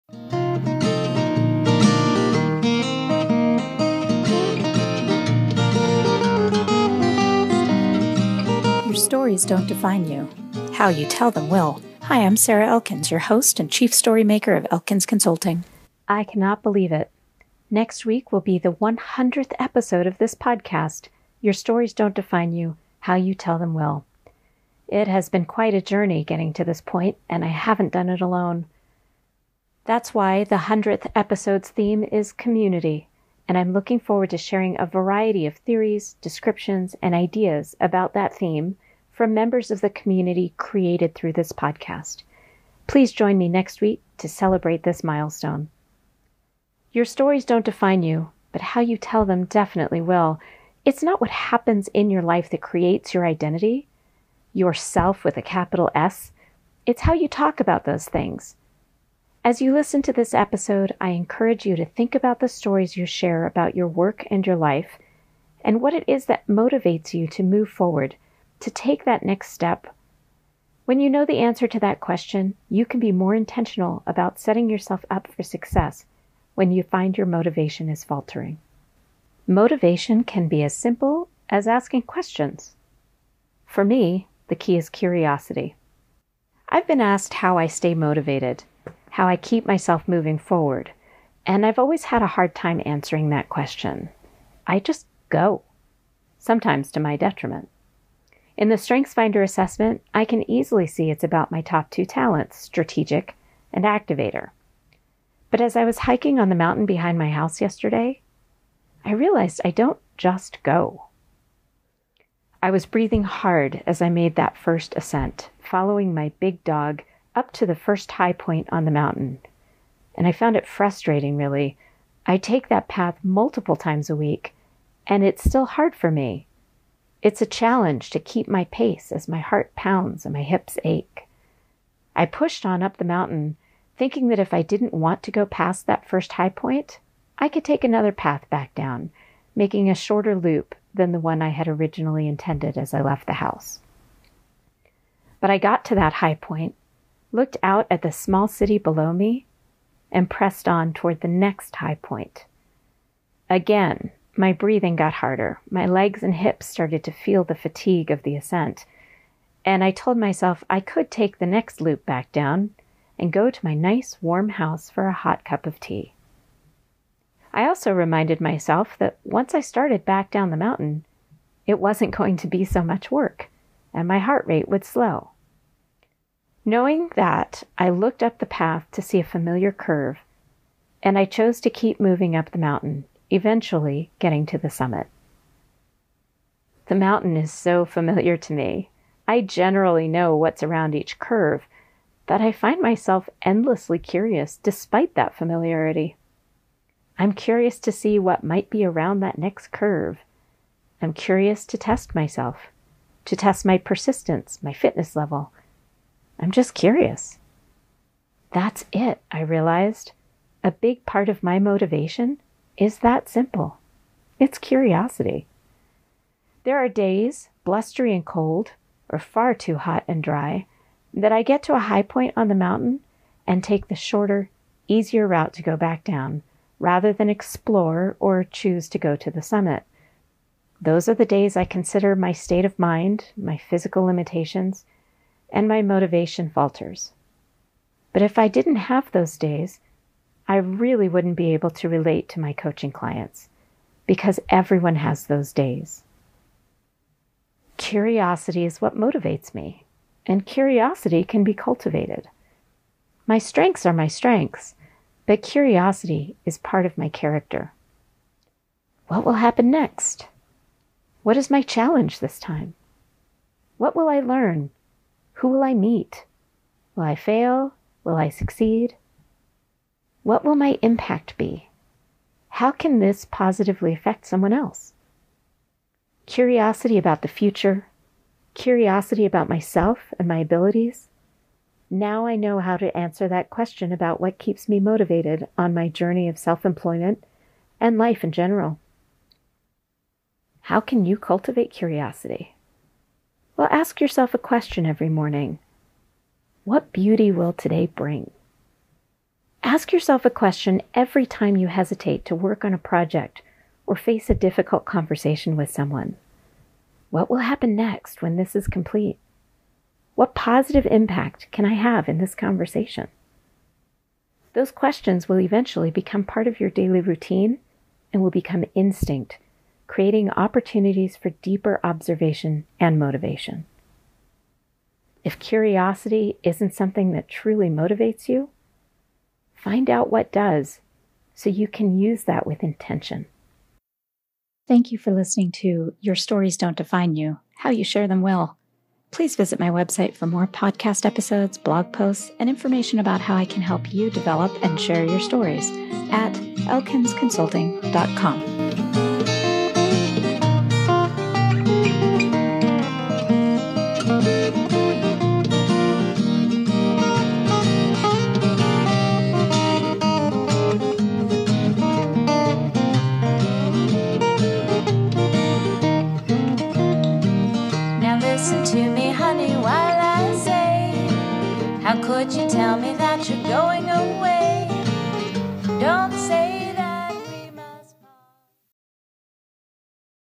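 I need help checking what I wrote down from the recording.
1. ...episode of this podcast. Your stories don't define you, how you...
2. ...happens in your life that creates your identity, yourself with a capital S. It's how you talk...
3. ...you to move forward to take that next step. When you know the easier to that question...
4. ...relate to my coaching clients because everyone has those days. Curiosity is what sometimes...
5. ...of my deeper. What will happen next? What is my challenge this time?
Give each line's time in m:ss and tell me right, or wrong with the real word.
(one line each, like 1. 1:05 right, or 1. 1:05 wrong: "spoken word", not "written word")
1. 0:19 right
2. 0:51 right
3. 1:07 wrong: "answer", not "easier"
4. 4:01 wrong: "motivates", not "sometimes"
5. 4:16 wrong: "character", not "deeper".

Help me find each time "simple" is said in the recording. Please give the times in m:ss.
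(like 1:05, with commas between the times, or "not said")
1:20, 3:33.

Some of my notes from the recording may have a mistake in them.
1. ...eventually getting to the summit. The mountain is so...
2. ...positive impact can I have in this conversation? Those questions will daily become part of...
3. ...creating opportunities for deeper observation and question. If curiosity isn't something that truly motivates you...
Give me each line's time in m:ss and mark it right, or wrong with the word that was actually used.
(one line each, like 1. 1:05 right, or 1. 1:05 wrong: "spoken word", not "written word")
1. 3:03 right
2. 5:10 wrong: "eventually", not "daily"
3. 5:19 wrong: "motivation", not "question".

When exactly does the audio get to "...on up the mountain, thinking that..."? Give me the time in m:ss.
2:12.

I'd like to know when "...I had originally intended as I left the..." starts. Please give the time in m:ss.
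2:21.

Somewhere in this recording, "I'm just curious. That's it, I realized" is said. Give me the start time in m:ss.
3:26.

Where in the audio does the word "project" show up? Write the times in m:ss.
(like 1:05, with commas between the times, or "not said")
5:02.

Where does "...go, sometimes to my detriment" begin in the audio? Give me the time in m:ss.
1:35.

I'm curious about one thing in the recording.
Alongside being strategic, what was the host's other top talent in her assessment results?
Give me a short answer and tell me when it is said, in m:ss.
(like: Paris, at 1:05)
activator, at 1:43.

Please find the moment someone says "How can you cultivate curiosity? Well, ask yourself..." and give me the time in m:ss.
4:50.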